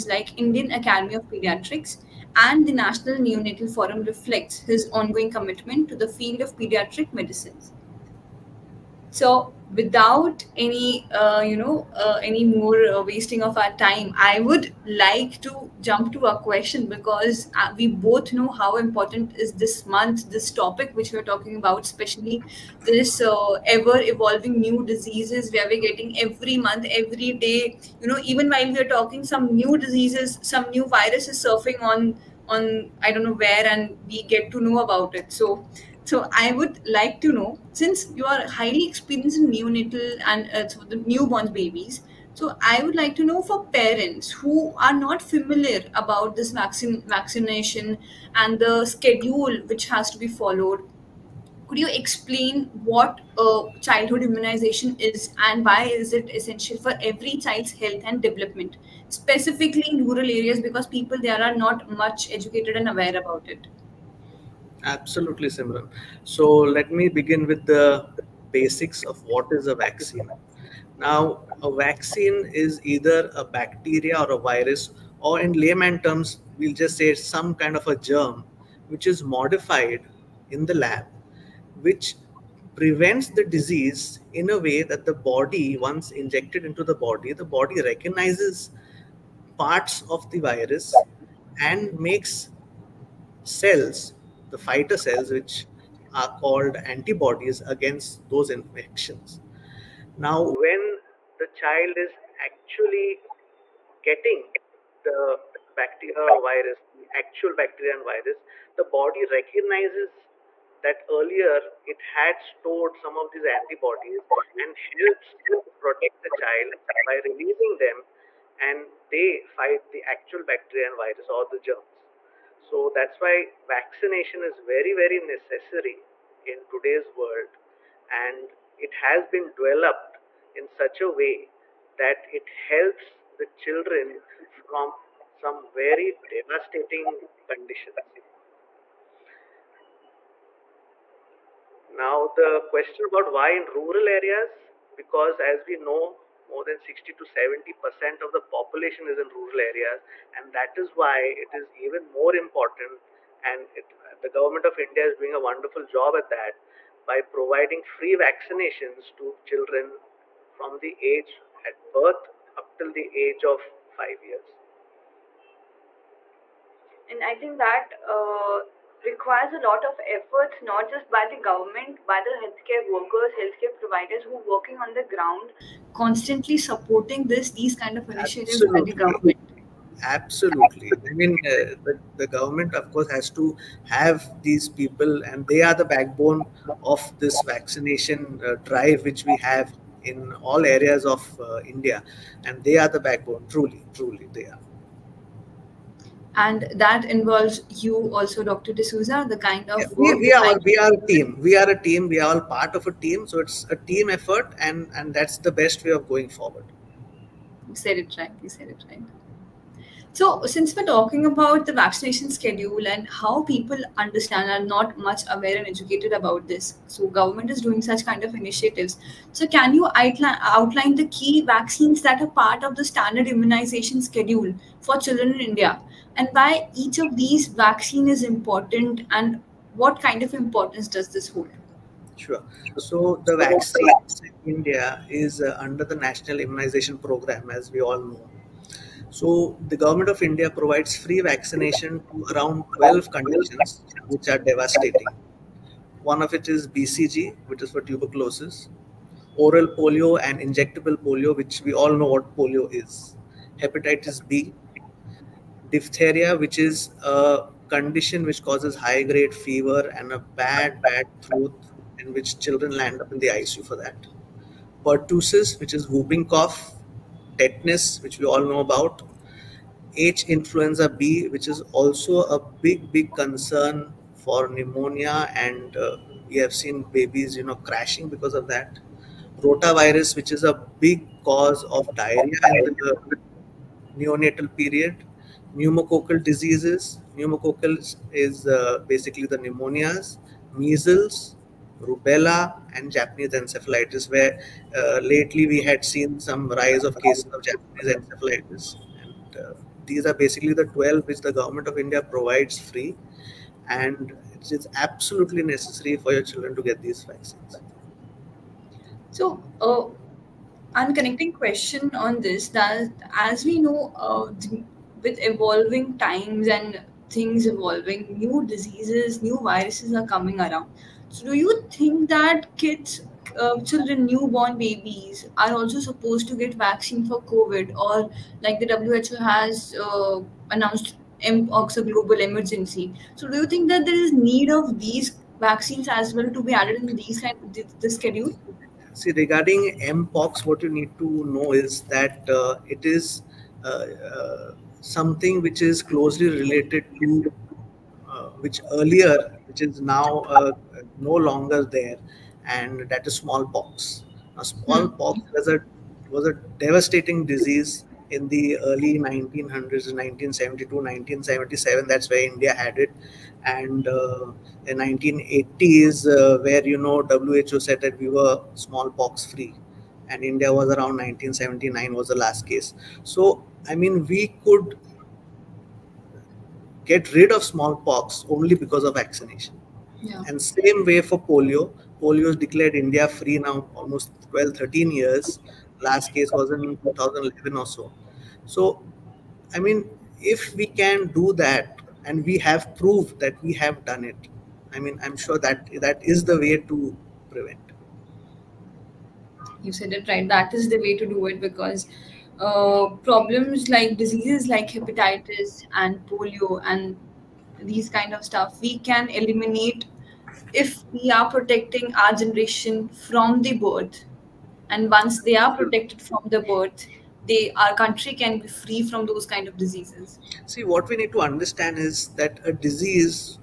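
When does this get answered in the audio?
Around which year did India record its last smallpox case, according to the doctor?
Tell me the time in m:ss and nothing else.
6:11.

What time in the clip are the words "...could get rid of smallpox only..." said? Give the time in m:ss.
6:14.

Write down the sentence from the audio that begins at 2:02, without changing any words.
So that's why vaccination is very, very necessary in today's world.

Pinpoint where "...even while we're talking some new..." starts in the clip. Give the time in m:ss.
0:28.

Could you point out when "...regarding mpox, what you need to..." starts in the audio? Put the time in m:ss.
5:39.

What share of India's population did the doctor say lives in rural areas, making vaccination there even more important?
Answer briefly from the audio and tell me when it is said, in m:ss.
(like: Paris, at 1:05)
60 to 70 percent, at 2:26.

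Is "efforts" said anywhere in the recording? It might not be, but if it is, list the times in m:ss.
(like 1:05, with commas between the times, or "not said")
2:50, 3:24.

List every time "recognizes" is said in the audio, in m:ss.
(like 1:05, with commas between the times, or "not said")
1:27, 1:49.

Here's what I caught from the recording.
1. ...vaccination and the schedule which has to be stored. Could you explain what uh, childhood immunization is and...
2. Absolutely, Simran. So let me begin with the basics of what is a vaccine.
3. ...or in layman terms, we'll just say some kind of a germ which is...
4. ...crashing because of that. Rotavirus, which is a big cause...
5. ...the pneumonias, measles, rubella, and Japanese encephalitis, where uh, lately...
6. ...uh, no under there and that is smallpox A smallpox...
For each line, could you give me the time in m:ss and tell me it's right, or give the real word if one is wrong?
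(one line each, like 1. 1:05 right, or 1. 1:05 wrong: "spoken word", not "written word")
1. 0:47 wrong: "followed", not "stored"
2. 1:04 right
3. 1:15 right
4. 4:37 right
5. 4:49 right
6. 5:50 wrong: "longer", not "under".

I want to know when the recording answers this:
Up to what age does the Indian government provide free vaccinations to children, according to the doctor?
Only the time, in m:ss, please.
2:44.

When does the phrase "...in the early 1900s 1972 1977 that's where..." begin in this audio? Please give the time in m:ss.
5:58.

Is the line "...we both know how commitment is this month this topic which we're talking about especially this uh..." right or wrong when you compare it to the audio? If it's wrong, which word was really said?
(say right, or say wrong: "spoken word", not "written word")
wrong: "important", not "commitment".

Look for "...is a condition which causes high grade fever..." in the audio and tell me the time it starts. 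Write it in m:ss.
4:16.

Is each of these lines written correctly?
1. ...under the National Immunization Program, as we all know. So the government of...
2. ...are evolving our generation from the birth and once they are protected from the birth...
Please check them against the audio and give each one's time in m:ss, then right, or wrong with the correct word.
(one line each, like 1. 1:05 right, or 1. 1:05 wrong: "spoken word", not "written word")
1. 3:55 right
2. 6:51 wrong: "protecting", not "evolving".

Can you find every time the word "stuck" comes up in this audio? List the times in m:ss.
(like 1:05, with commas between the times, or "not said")
not said.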